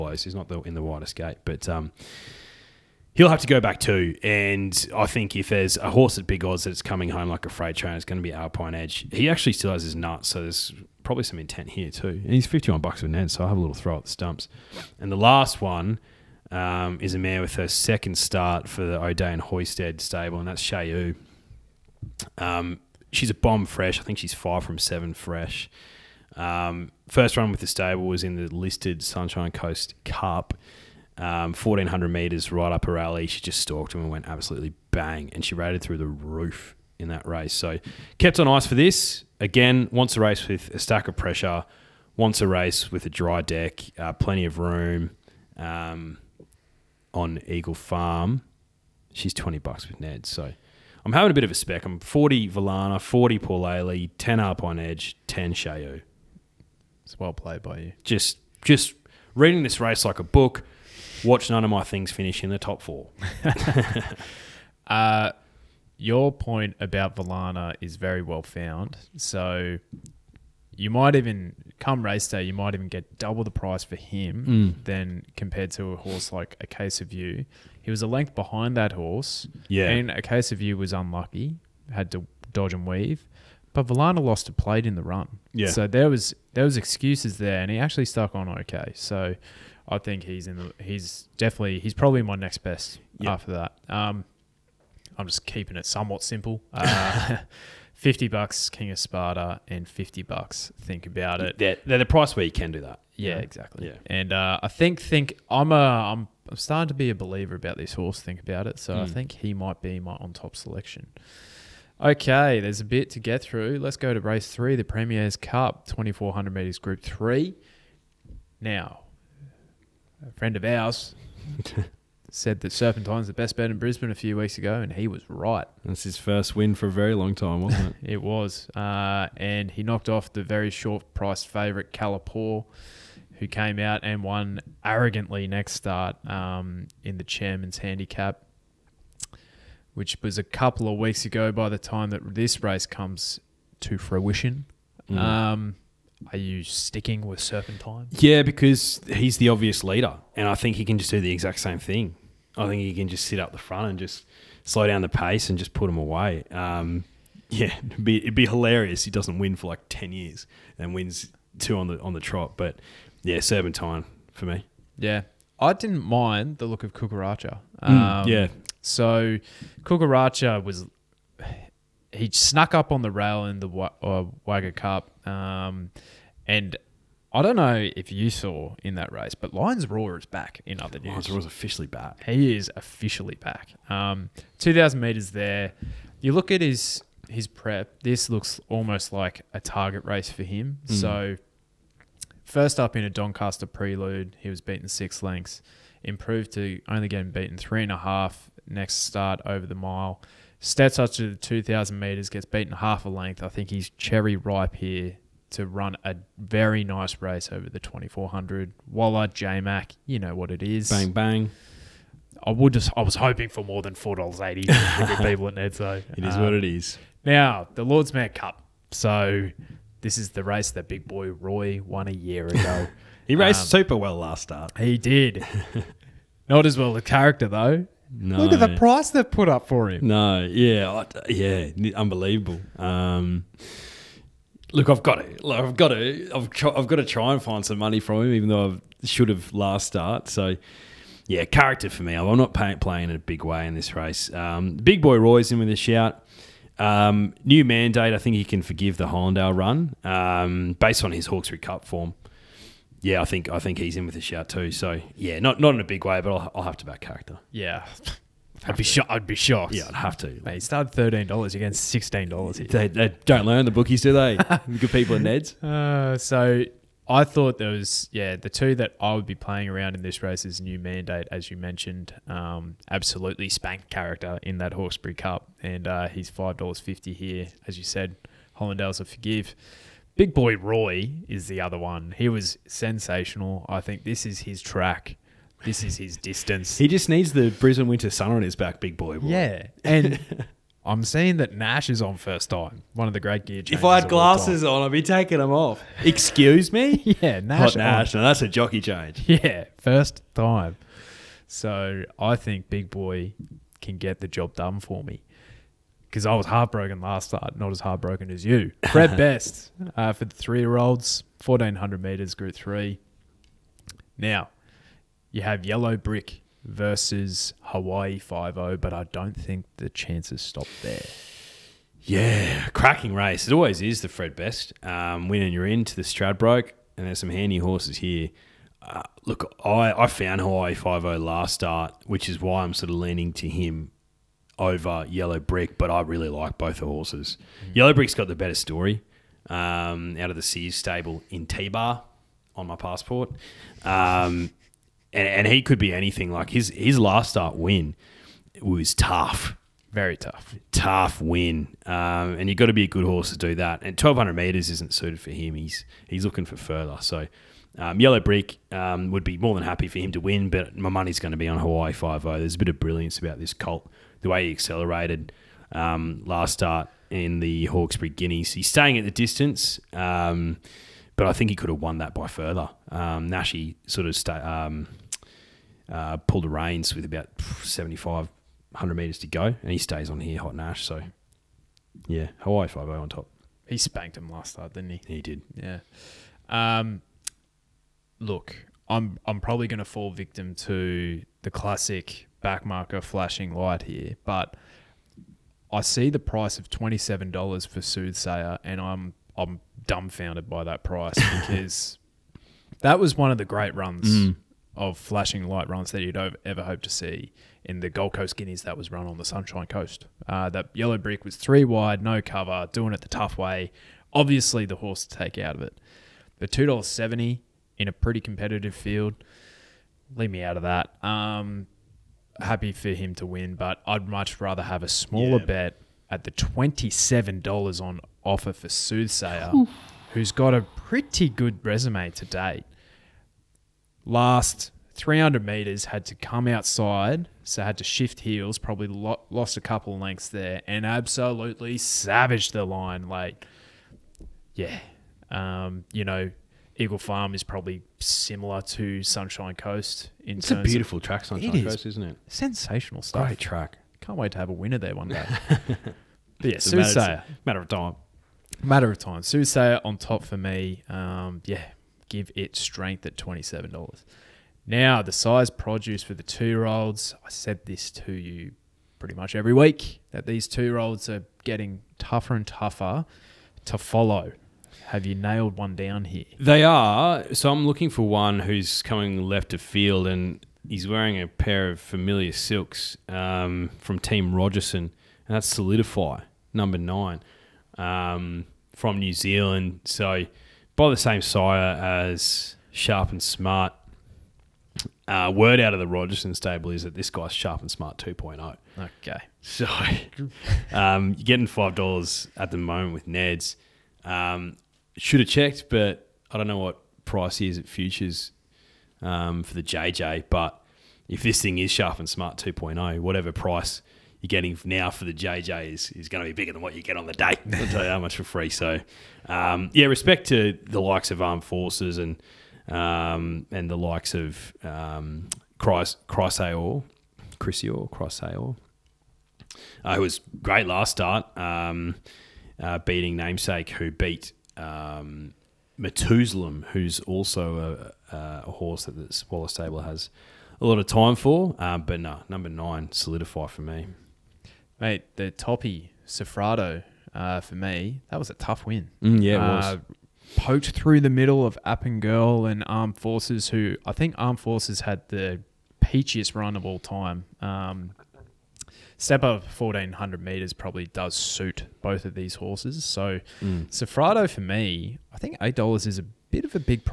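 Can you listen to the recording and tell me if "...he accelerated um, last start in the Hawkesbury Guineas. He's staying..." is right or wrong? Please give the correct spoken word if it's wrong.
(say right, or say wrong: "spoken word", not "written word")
right.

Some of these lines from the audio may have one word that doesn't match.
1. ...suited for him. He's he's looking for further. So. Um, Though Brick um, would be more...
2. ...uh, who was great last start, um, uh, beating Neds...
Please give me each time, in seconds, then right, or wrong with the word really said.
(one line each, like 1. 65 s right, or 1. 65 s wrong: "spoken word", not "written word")
1. 354 s wrong: "Yellow", not "Though"
2. 529 s wrong: "Namesake", not "Neds".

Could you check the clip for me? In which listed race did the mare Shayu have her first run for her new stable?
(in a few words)
Sunshine Coast Cup.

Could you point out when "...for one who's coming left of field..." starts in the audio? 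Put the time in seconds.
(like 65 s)
477 s.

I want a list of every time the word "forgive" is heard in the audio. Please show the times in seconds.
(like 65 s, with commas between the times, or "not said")
248 s, 279 s.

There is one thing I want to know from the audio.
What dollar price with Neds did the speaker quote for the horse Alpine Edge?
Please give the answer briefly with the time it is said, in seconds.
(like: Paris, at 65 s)
51, at 12 s.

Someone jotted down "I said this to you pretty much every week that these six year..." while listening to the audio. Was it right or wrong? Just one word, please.
wrong.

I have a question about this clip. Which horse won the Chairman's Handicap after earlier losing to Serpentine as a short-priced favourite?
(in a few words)
Calipor.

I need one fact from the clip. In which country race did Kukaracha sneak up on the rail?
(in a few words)
Wagga Cup.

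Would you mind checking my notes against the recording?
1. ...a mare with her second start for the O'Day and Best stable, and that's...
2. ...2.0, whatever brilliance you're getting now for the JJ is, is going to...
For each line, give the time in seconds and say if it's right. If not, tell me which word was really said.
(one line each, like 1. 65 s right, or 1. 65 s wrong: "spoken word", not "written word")
1. 17 s wrong: "Hoisted", not "Best"
2. 512 s wrong: "price", not "brilliance".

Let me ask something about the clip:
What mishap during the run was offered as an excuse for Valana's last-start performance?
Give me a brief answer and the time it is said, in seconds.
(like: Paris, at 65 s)
Lost a plate, at 84 s.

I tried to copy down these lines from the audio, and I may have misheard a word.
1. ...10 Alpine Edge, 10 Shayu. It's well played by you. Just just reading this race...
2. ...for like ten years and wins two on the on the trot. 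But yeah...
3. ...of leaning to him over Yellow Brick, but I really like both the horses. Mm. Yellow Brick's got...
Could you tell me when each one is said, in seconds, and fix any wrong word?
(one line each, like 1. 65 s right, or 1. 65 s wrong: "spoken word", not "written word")
1. 54 s right
2. 159 s right
3. 332 s right.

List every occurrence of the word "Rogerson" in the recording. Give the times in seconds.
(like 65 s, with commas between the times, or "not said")
484 s, 495 s.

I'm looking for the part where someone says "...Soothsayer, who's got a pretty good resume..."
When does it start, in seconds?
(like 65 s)
428 s.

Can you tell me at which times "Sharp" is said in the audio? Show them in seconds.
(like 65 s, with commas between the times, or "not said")
492 s, 497 s, 511 s.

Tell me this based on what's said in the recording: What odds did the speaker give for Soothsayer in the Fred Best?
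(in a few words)
$27.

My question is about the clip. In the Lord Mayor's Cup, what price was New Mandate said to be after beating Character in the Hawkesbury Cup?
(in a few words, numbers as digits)
$5.50.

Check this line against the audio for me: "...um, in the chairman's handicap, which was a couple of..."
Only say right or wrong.
right.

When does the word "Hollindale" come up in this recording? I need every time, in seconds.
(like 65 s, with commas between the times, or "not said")
249 s, 278 s.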